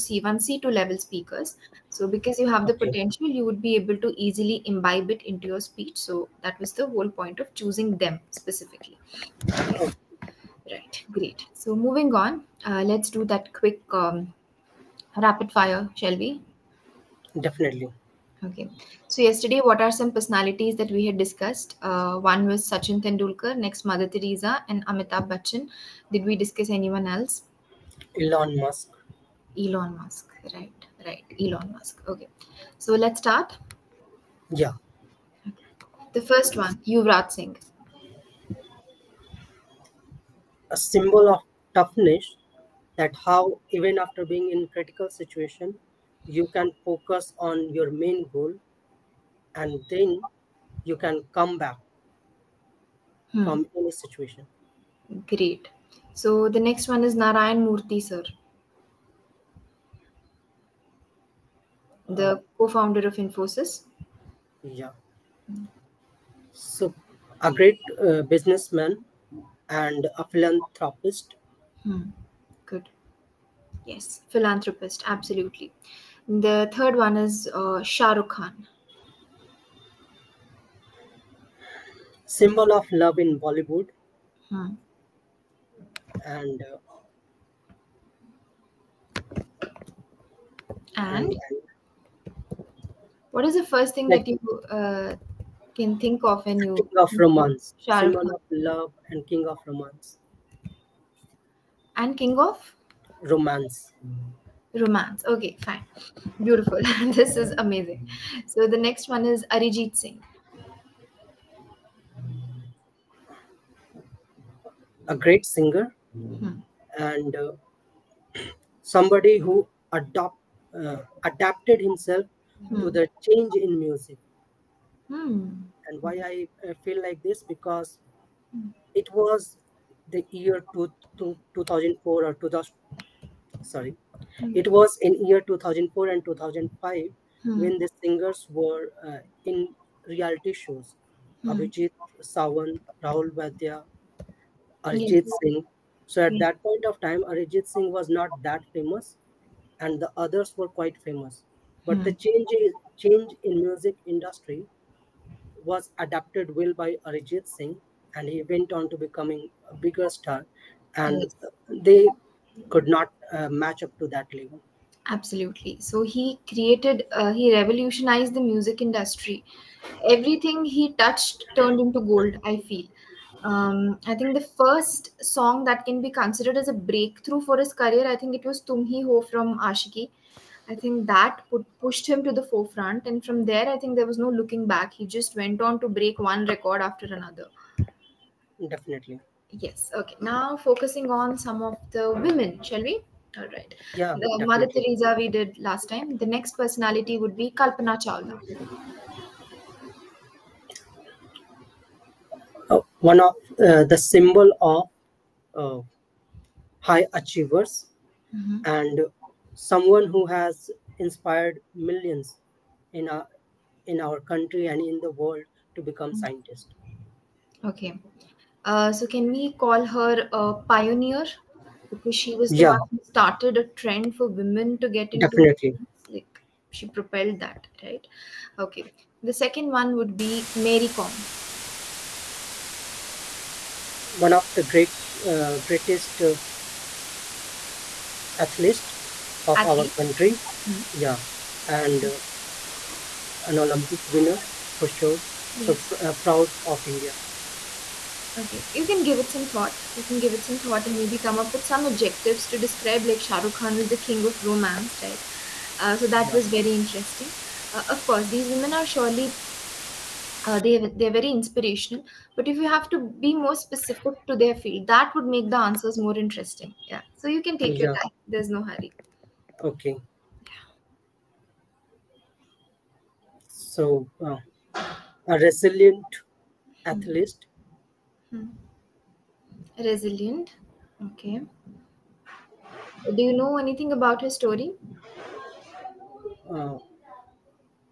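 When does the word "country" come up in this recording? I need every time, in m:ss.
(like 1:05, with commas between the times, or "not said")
3:34, 4:00.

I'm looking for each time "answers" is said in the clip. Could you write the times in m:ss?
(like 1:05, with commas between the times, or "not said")
4:25.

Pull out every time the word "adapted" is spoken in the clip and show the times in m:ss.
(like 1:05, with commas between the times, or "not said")
2:01, 2:35.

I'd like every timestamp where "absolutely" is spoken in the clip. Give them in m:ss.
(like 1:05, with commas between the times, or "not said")
1:15, 2:45.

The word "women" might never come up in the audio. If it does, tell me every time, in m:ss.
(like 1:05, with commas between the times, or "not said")
3:12, 3:44, 4:18.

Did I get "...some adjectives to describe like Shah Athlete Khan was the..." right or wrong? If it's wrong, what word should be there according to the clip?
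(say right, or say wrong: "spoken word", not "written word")
wrong: "Rukh", not "Athlete".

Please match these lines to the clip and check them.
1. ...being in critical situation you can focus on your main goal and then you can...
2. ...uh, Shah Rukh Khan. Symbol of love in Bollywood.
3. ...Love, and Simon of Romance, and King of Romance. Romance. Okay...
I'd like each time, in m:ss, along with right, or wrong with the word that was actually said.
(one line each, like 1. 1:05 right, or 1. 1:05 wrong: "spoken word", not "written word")
1. 0:44 right
2. 1:17 right
3. 1:38 wrong: "King", not "Simon".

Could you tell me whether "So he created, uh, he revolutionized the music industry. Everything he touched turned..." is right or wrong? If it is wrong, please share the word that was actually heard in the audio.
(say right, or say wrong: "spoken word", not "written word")
right.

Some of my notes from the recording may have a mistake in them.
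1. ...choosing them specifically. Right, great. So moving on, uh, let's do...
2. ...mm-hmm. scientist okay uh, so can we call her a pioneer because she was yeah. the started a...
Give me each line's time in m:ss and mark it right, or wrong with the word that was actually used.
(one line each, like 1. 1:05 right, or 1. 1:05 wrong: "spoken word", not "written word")
1. 0:07 right
2. 3:36 right.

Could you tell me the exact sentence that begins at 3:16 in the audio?
The next personality would be Kalpana Chawla.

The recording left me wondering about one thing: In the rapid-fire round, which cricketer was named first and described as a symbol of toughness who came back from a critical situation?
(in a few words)
Yuvraj Singh.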